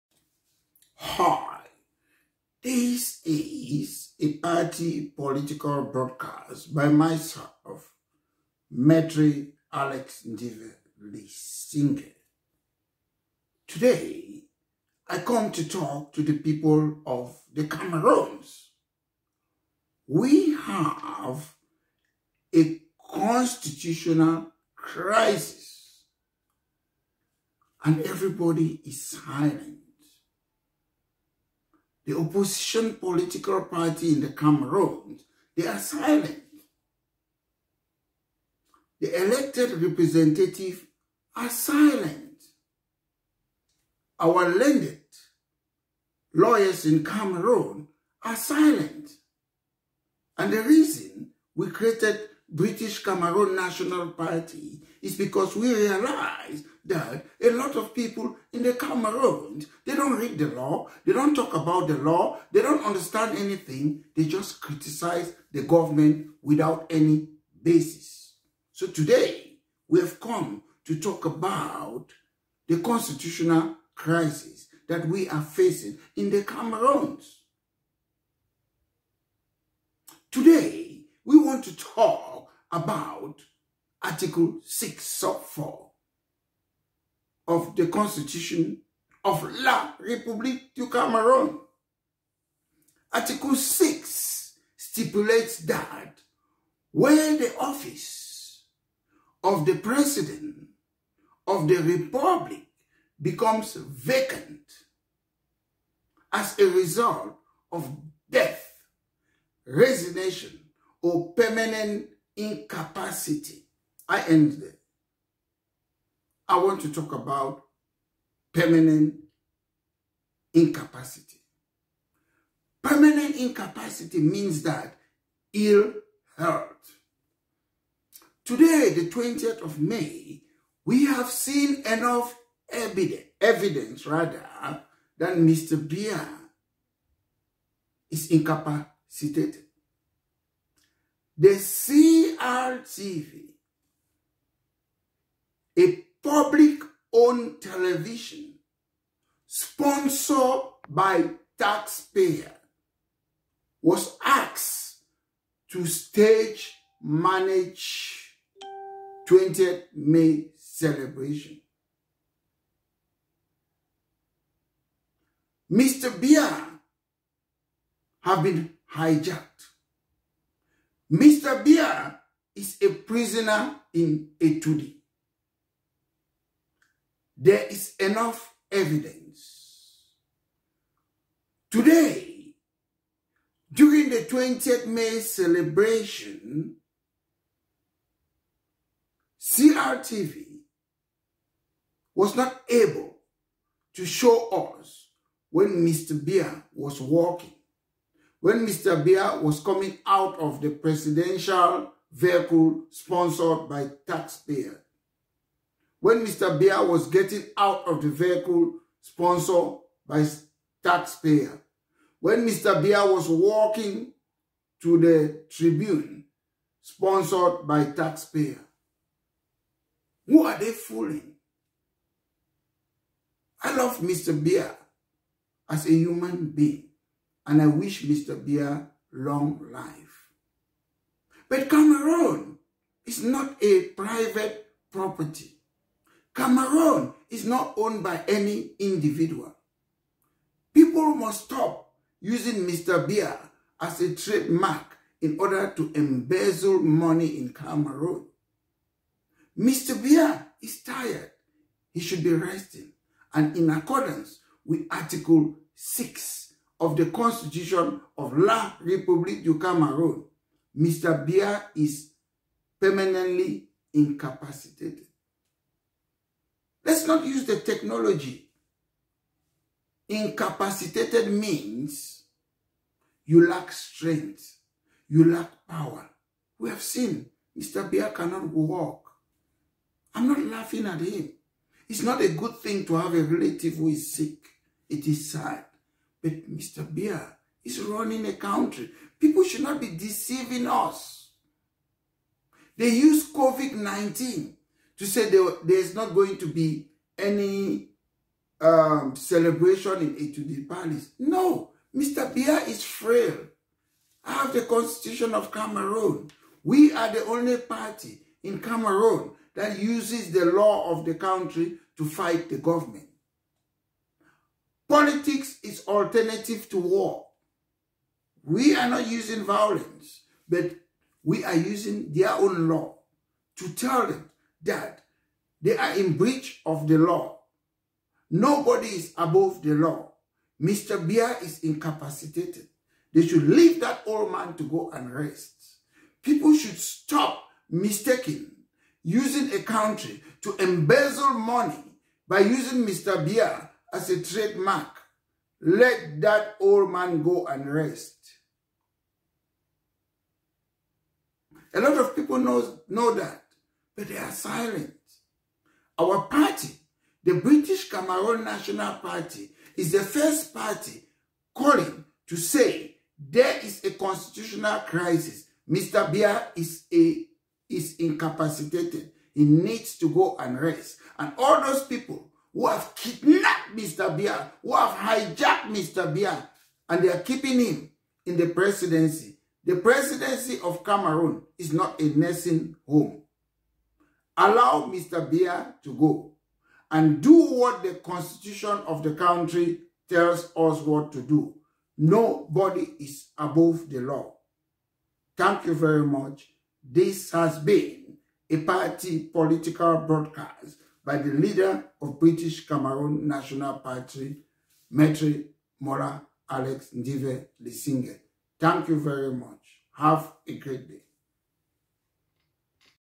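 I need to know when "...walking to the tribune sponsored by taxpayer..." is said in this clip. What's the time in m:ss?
3:33.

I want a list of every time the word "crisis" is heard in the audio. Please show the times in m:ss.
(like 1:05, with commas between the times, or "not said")
0:24, 1:13, 6:04.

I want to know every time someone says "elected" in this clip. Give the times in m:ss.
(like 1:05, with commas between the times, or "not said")
0:39.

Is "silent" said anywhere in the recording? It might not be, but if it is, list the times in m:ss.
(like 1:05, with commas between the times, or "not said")
0:29, 0:35, 0:41, 0:48, 5:54.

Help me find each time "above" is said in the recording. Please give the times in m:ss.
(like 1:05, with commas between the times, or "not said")
5:29, 6:33.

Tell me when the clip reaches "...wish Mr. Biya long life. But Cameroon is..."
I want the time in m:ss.
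3:47.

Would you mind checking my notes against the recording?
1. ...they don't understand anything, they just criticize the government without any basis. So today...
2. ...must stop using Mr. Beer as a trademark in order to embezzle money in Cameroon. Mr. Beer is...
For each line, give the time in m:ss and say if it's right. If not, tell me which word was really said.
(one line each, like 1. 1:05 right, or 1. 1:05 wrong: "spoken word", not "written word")
1. 1:02 right
2. 4:01 right.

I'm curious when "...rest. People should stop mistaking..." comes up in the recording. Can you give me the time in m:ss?
5:35.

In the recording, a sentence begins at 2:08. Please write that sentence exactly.
Today, the 20th of May, we have seen enough evidence, evidence rather, that Mr.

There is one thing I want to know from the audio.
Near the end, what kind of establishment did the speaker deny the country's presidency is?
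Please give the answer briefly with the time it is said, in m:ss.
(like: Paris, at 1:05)
A nursing home, at 6:22.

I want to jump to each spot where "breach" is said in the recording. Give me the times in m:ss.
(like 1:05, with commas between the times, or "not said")
5:26.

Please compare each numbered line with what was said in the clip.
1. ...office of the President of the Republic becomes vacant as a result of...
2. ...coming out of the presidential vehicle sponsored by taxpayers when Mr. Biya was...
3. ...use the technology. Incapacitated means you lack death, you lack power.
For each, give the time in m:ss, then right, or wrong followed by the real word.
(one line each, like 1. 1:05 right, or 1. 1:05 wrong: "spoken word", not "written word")
1. 1:37 right
2. 3:19 right
3. 4:27 wrong: "strength", not "death".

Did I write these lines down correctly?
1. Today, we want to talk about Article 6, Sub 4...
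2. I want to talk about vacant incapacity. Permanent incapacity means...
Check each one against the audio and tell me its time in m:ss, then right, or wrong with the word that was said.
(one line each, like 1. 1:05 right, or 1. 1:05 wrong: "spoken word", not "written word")
1. 1:20 right
2. 1:56 wrong: "permanent", not "vacant".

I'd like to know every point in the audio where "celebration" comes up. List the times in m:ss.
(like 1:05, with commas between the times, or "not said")
2:40, 3:05, 4:59.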